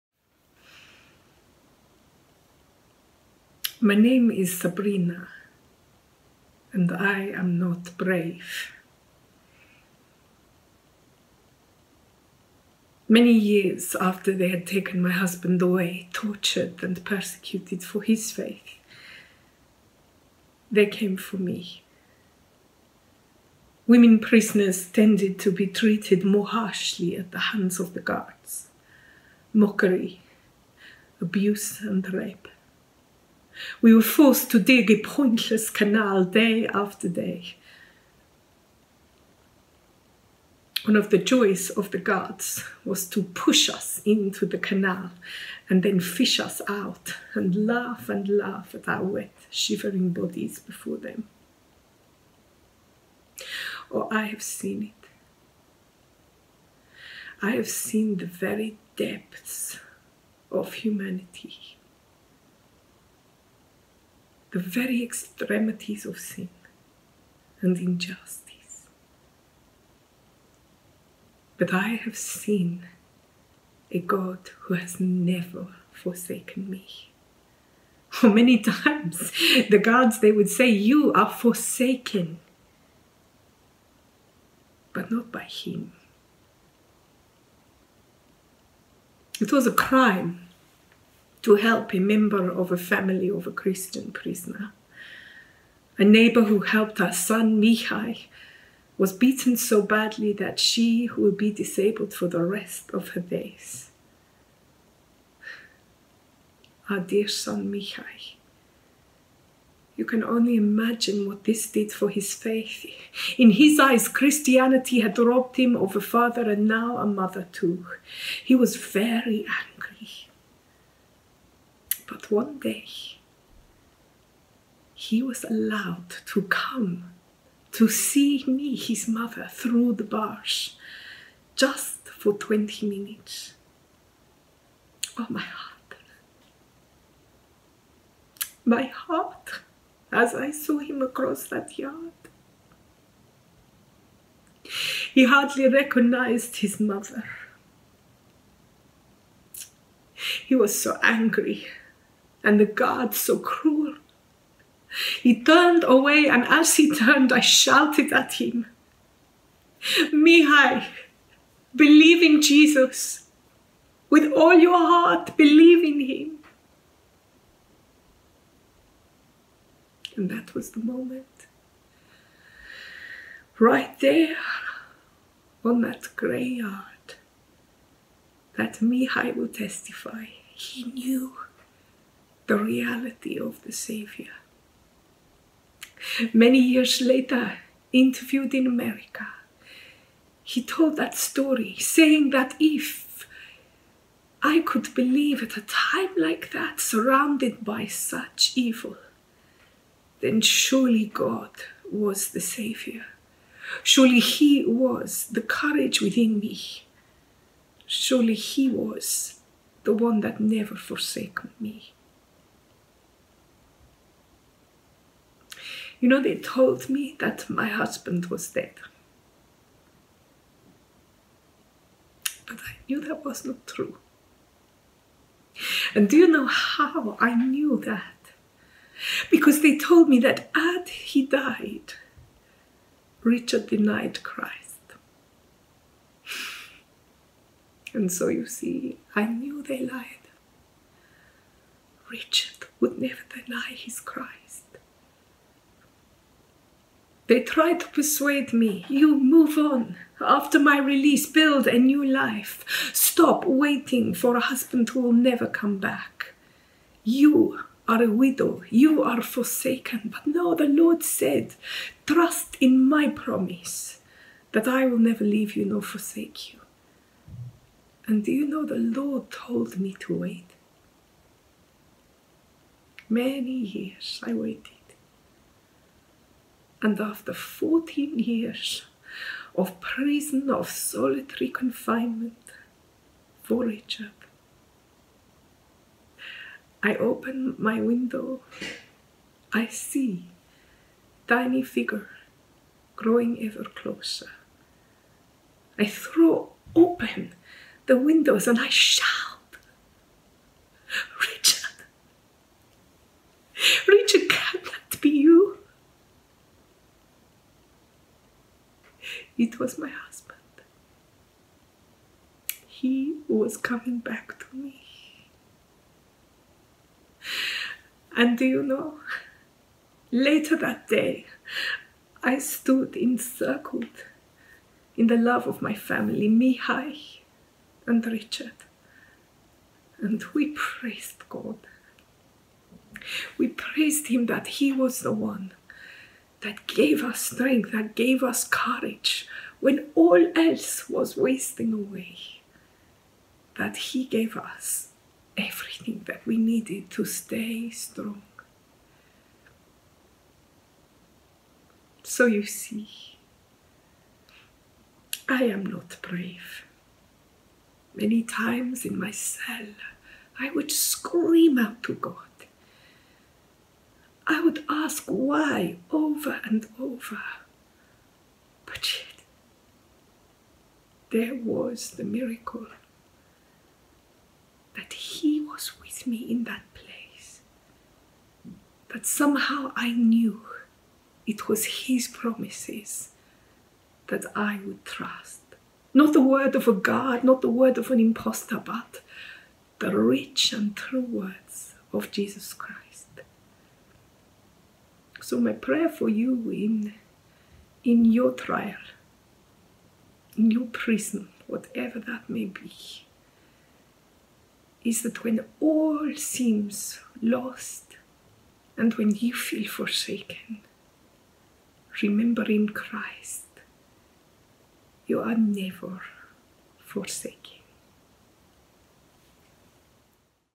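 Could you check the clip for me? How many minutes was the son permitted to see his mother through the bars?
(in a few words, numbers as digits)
20.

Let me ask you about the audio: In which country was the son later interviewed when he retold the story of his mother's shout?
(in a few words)
America.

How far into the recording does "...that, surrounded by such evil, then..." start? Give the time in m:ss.
3:16.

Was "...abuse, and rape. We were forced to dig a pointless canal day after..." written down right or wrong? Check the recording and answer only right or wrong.
right.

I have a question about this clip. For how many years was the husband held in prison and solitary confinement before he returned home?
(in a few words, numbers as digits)
14.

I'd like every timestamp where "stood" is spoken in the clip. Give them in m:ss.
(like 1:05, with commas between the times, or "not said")
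5:22.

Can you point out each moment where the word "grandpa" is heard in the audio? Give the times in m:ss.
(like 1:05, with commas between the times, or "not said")
not said.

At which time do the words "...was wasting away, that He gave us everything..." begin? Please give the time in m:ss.
5:40.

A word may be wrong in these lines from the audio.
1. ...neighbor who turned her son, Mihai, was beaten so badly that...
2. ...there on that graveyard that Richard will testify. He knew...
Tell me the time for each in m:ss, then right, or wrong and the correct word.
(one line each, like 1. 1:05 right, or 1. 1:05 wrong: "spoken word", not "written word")
1. 1:36 wrong: "helped", not "turned"
2. 2:54 wrong: "Mihai", not "Richard".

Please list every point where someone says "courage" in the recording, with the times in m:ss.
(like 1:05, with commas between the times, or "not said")
3:25, 5:38.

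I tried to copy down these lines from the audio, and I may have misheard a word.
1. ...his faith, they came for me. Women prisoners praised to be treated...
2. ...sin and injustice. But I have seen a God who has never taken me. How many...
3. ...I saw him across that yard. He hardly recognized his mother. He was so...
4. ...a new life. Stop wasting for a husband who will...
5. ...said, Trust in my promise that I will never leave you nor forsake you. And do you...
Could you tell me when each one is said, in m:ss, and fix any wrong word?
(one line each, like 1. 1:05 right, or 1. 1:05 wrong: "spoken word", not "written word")
1. 0:18 wrong: "tended", not "praised"
2. 1:06 wrong: "forsaken", not "taken"
3. 2:20 right
4. 4:11 wrong: "waiting", not "wasting"
5. 4:21 right.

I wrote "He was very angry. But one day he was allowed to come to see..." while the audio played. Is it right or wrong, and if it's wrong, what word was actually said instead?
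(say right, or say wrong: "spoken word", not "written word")
right.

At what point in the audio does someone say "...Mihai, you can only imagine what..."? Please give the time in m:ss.
1:47.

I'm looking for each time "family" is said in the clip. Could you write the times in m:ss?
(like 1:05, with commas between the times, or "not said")
1:32, 5:25.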